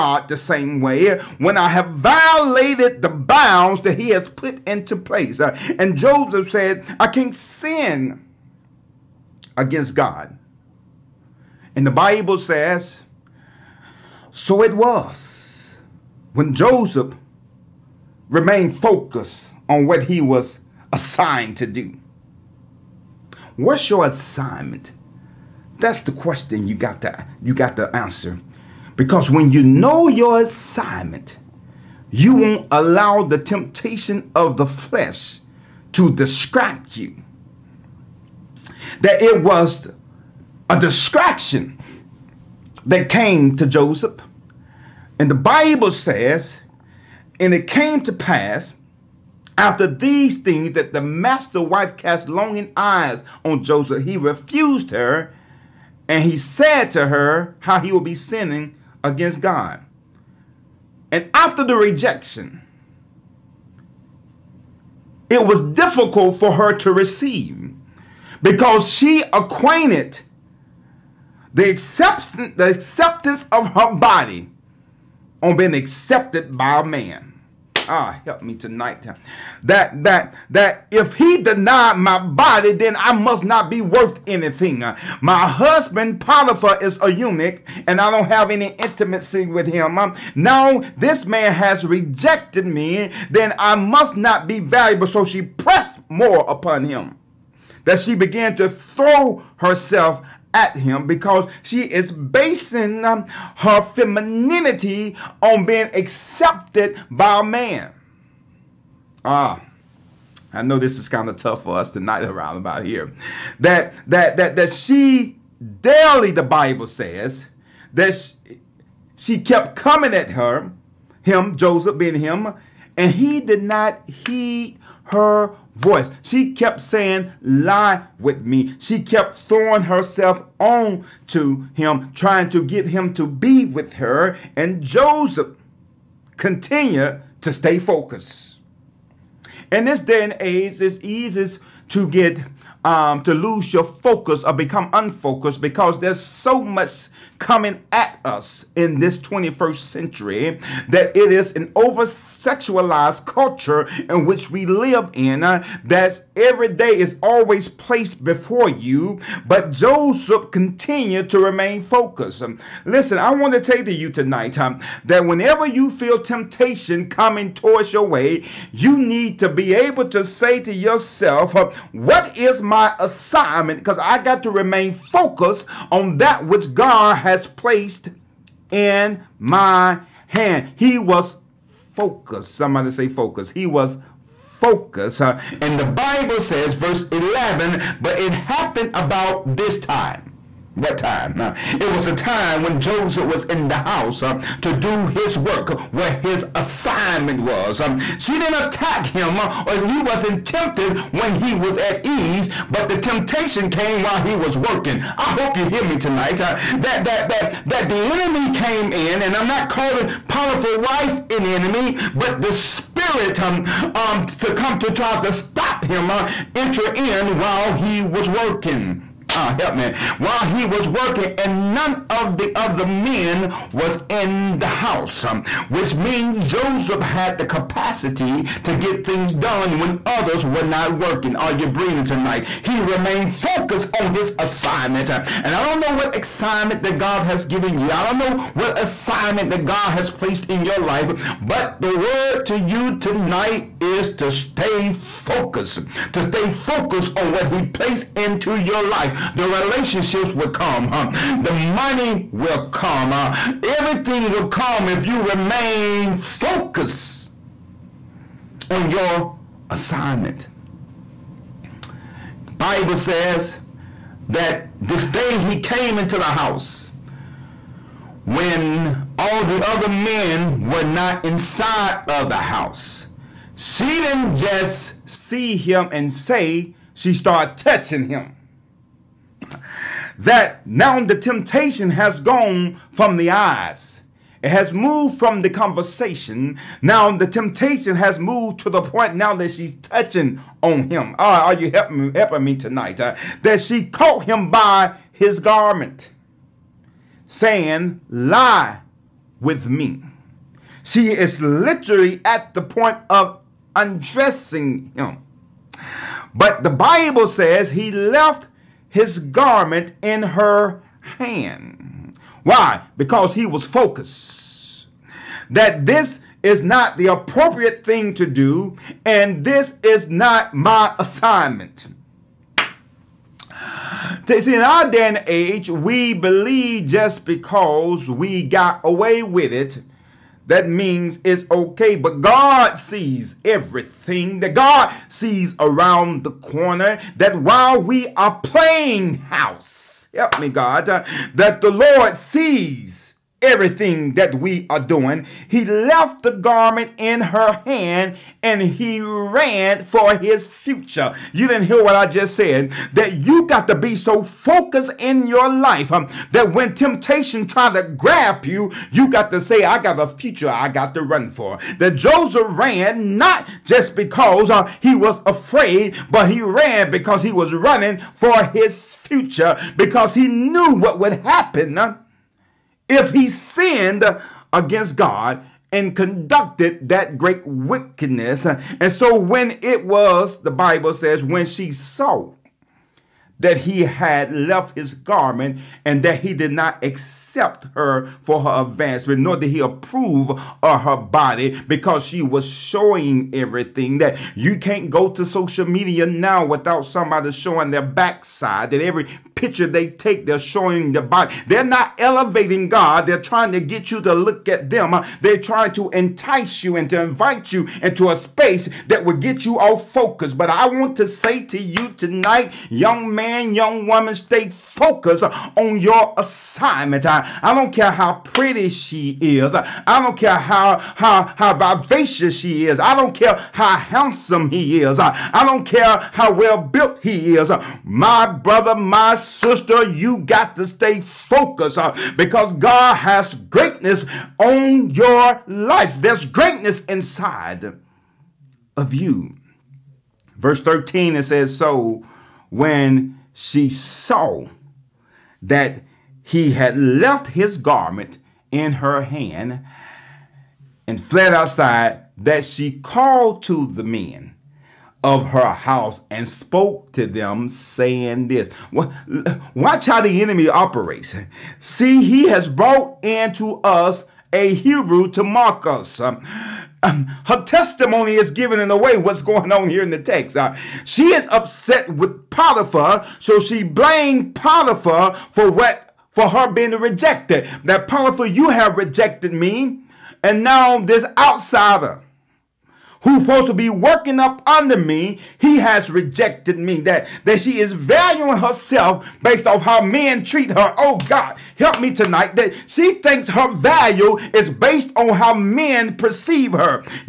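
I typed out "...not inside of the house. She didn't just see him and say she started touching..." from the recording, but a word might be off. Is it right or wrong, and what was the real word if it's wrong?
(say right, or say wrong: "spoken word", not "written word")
right.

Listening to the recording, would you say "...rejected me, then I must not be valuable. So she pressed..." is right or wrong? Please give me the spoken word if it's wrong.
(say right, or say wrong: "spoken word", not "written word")
right.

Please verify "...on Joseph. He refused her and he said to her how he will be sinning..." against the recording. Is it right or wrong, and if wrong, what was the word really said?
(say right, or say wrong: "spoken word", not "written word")
right.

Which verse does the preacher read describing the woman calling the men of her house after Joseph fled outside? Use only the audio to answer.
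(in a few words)
13.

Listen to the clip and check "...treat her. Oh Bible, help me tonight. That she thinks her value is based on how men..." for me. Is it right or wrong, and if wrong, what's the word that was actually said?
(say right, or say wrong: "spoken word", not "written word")
wrong: "God", not "Bible".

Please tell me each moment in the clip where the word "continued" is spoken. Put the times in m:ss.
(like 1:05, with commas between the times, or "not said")
2:16, 2:40.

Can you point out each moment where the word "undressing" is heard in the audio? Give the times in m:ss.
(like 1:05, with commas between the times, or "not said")
5:03.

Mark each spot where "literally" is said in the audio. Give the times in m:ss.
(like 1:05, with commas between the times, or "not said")
5:01.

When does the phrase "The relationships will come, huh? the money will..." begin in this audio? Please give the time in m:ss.
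4:09.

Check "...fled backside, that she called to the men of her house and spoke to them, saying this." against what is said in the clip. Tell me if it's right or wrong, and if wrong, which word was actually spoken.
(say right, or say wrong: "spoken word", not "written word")
wrong: "outside", not "backside".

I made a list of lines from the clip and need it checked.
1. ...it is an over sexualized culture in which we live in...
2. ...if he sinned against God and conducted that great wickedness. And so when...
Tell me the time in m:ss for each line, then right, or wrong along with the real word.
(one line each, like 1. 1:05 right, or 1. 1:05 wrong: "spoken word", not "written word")
1. 2:31 right
2. 6:12 right.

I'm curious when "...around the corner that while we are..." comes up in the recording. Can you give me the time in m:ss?
5:35.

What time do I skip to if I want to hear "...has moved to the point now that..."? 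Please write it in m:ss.
4:47.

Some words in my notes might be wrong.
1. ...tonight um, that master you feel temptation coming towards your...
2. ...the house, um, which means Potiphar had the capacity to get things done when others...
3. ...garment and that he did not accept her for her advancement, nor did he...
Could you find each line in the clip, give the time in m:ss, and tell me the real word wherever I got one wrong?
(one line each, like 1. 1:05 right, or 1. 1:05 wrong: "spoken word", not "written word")
1. 2:44 wrong: "whenever", not "master"
2. 3:44 wrong: "Joseph", not "Potiphar"
3. 6:24 right.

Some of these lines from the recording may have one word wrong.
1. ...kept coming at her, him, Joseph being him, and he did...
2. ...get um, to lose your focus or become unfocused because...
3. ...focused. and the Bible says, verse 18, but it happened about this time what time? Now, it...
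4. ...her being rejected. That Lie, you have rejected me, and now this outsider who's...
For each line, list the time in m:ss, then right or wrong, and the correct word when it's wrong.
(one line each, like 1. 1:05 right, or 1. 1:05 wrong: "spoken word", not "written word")
1. 1:59 right
2. 2:22 right
3. 3:04 wrong: "11", not "18"
4. 7:56 wrong: "Potiphar", not "Lie".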